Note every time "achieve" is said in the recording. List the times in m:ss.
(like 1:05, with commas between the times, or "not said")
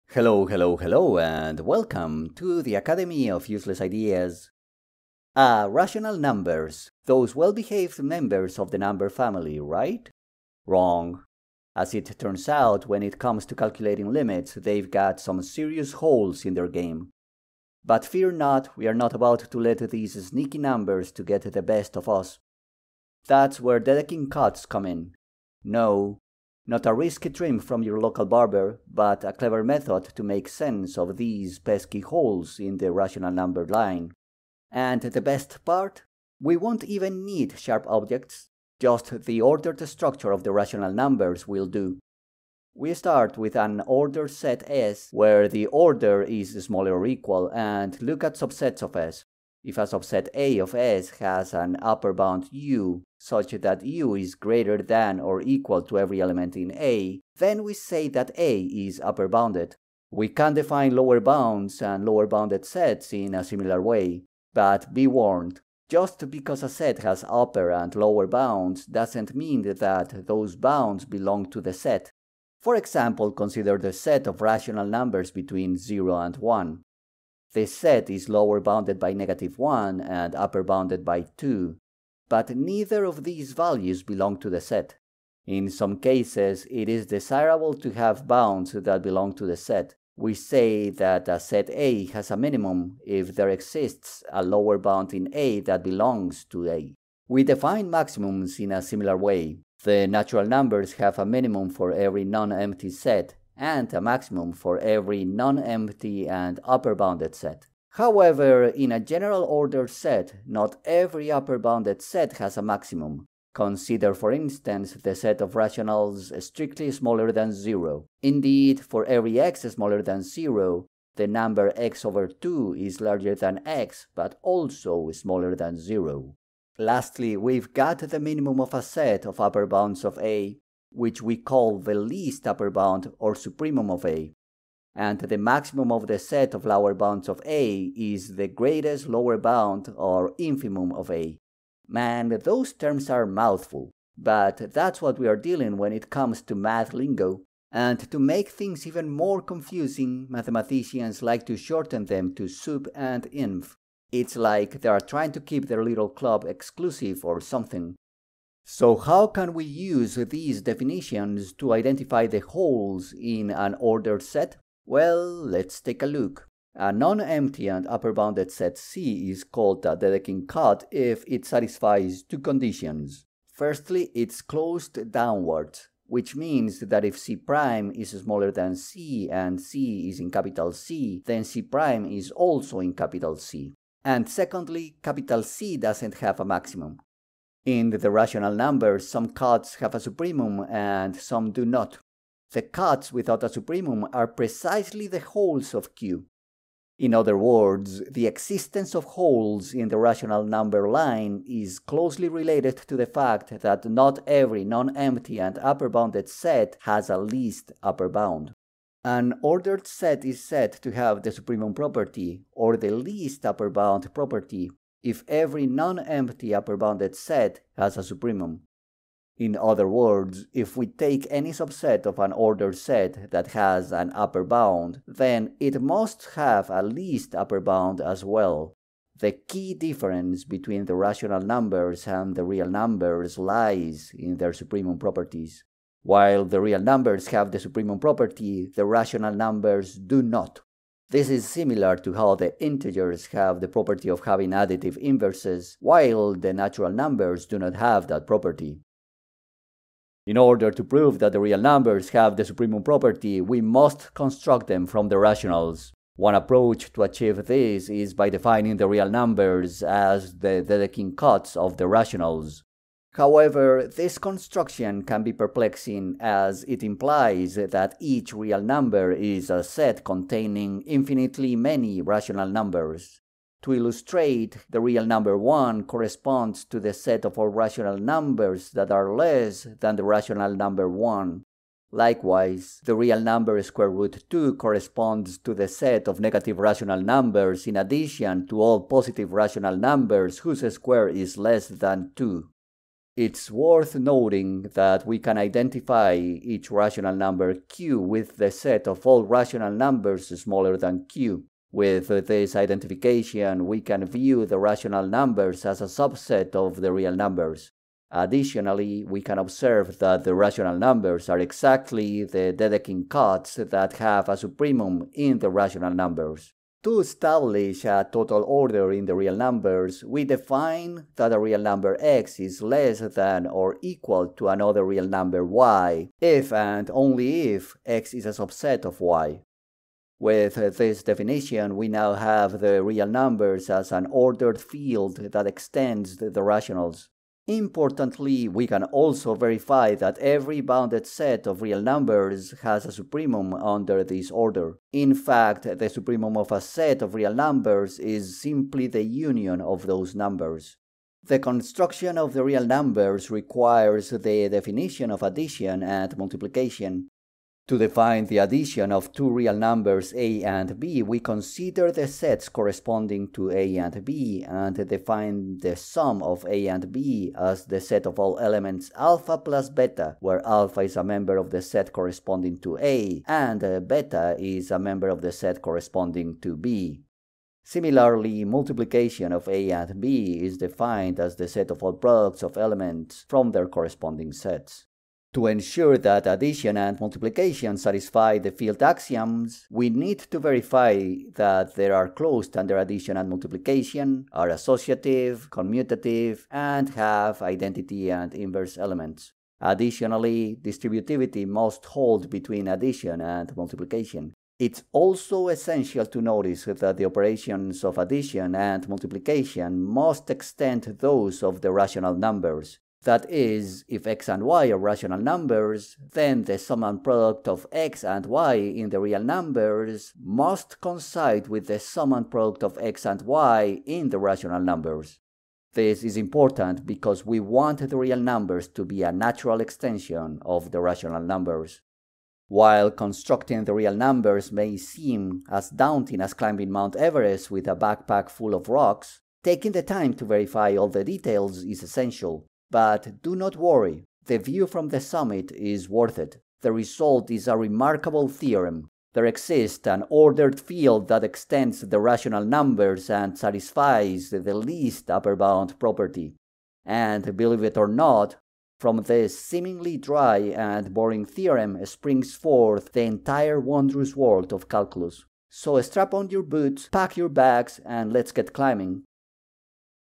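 4:17.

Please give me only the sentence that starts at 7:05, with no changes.
This is important because we want the real numbers to be a natural extension of the rational numbers.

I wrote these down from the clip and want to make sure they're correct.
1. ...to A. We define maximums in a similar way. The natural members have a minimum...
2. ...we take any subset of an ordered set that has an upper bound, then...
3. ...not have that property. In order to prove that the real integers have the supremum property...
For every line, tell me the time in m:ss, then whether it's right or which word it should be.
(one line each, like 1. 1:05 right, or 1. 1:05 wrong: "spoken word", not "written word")
1. 1:36 wrong: "numbers", not "members"
2. 3:40 right
3. 4:07 wrong: "numbers", not "integers".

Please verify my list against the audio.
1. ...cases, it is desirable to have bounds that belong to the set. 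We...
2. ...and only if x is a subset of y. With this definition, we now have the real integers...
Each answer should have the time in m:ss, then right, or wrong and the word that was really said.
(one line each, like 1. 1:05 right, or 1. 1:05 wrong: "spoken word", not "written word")
1. 1:25 right
2. 5:26 wrong: "numbers", not "integers".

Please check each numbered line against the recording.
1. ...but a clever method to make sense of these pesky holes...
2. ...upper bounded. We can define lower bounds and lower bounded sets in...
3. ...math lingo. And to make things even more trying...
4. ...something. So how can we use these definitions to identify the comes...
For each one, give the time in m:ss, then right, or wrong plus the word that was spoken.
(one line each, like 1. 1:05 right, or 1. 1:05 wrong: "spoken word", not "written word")
1. 0:28 right
2. 0:59 right
3. 2:26 wrong: "confusing", not "trying"
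4. 2:37 wrong: "holes", not "comes".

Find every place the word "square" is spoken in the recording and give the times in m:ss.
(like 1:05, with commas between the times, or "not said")
4:43, 4:50.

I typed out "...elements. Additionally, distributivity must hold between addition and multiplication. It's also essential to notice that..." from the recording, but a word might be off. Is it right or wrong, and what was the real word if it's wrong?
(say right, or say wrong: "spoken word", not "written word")
right.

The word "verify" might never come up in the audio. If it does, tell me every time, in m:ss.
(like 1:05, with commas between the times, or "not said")
5:39, 6:30, 7:20.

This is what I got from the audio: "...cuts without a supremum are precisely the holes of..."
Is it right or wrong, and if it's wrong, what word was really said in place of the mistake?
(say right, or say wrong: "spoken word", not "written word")
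right.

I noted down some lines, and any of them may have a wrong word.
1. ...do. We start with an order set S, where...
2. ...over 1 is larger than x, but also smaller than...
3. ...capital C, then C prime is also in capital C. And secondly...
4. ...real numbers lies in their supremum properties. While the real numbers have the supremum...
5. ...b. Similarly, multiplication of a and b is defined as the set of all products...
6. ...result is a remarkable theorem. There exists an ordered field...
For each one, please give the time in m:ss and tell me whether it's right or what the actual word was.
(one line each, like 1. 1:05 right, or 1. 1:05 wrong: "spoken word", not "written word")
1. 0:41 right
2. 2:02 wrong: "2", not "1"
3. 3:00 right
4. 3:52 right
5. 6:16 right
6. 7:26 right.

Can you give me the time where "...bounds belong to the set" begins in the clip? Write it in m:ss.
1:10.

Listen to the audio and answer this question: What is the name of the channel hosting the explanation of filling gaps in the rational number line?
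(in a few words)
Academy of Useless Ideas.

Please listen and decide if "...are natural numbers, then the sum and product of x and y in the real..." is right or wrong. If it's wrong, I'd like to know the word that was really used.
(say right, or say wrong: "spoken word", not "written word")
wrong: "rational", not "natural".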